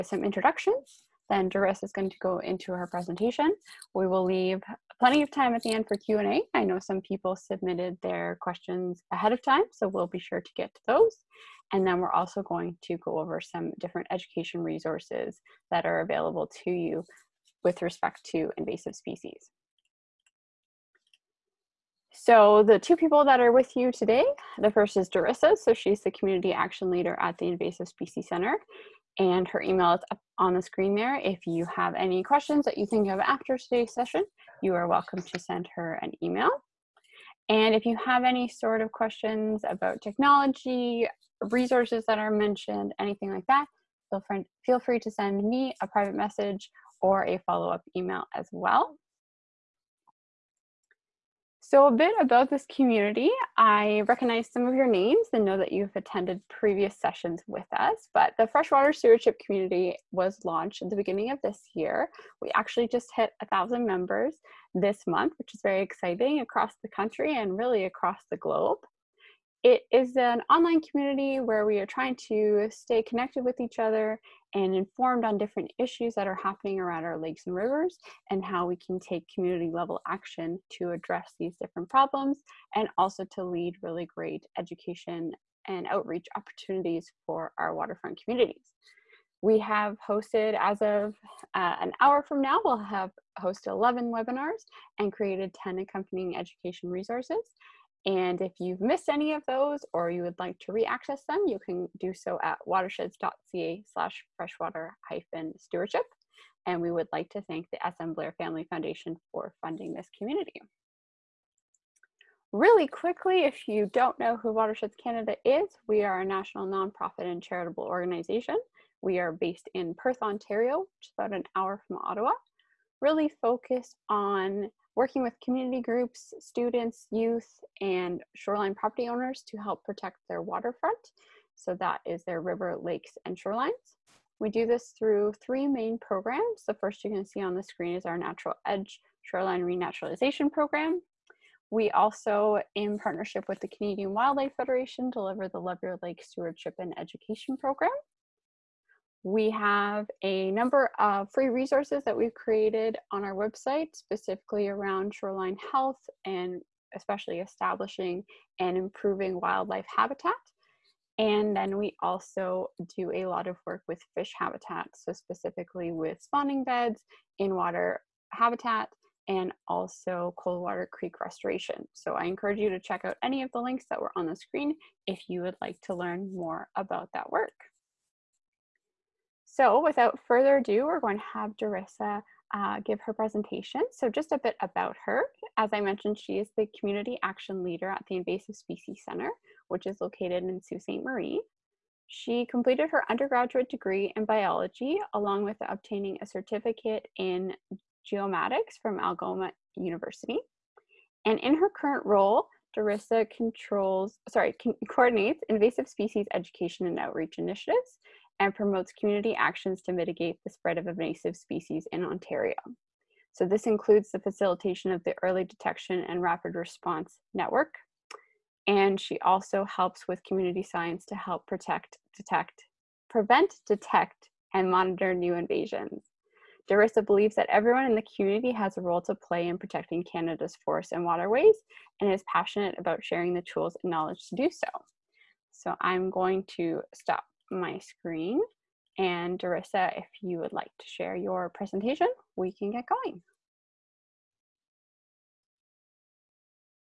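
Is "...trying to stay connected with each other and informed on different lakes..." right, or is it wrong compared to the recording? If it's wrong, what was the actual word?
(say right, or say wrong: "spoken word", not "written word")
wrong: "issues", not "lakes".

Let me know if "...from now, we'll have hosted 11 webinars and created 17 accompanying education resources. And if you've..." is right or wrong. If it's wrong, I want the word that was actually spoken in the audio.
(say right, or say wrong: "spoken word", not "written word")
wrong: "10", not "17".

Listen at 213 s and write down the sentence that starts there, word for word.
So this includes the facilitation of the early detection and rapid response network.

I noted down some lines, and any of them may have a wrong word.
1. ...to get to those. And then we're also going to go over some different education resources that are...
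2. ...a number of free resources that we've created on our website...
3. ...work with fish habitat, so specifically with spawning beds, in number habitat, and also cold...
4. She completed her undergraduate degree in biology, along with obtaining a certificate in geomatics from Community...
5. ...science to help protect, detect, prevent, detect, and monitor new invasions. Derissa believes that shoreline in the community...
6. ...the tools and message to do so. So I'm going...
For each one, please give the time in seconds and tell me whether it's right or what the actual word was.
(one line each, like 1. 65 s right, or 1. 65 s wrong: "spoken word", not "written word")
1. 10 s right
2. 150 s right
3. 163 s wrong: "water", not "number"
4. 192 s wrong: "Algoma", not "Community"
5. 220 s wrong: "everyone", not "shoreline"
6. 233 s wrong: "knowledge", not "message".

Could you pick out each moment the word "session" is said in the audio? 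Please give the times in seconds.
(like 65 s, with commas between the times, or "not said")
33 s, 56 s.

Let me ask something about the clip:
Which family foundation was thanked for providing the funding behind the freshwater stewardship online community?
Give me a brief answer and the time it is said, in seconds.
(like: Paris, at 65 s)
SM Blair Family Foundation, at 107 s.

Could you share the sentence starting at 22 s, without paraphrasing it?
So the two people that are with you today, the first is Derissa.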